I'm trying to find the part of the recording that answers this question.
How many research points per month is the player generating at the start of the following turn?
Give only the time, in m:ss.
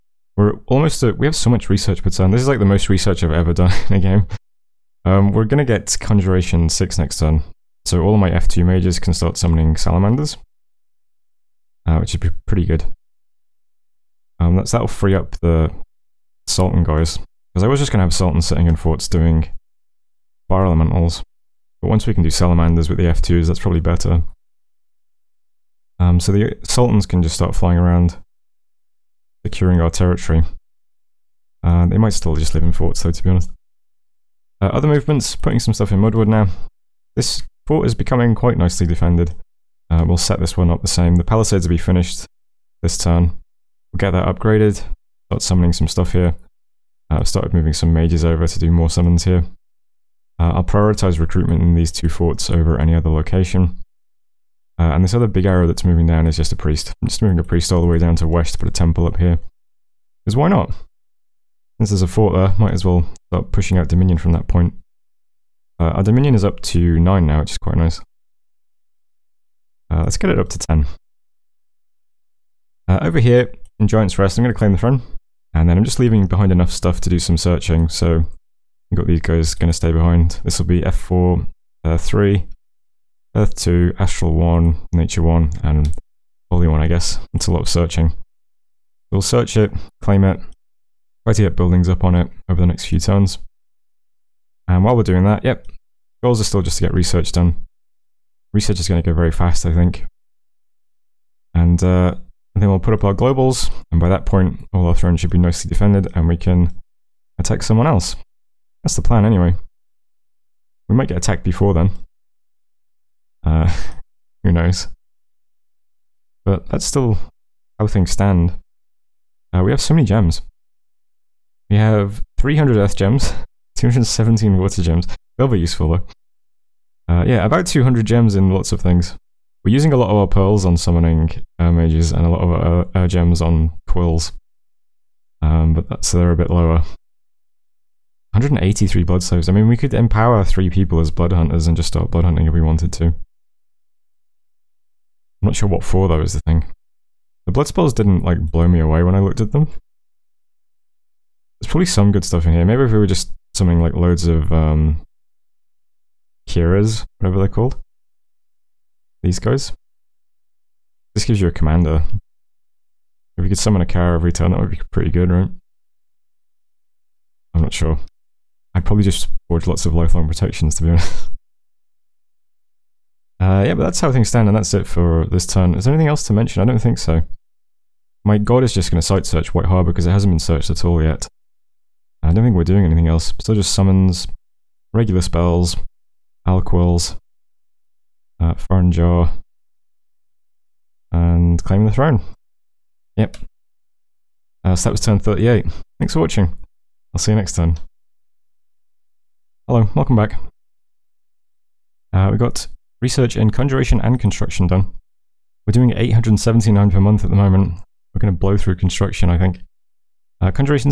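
3:25.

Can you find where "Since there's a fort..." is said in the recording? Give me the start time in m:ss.
1:01.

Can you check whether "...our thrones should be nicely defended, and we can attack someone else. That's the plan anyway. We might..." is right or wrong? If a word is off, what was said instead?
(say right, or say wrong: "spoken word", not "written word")
right.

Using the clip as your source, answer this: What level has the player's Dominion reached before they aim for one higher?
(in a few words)
9.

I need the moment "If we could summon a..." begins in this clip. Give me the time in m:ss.
2:43.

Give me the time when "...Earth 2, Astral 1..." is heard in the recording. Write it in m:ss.
1:23.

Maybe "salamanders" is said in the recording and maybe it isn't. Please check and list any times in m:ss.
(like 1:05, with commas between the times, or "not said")
0:09, 0:22.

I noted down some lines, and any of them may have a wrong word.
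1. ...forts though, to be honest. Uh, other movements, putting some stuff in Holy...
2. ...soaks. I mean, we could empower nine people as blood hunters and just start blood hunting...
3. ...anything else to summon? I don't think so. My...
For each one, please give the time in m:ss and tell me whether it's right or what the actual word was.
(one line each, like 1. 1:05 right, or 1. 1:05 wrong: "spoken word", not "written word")
1. 0:32 wrong: "Mudwood", not "Holy"
2. 2:19 wrong: "three", not "nine"
3. 2:55 wrong: "mention", not "summon".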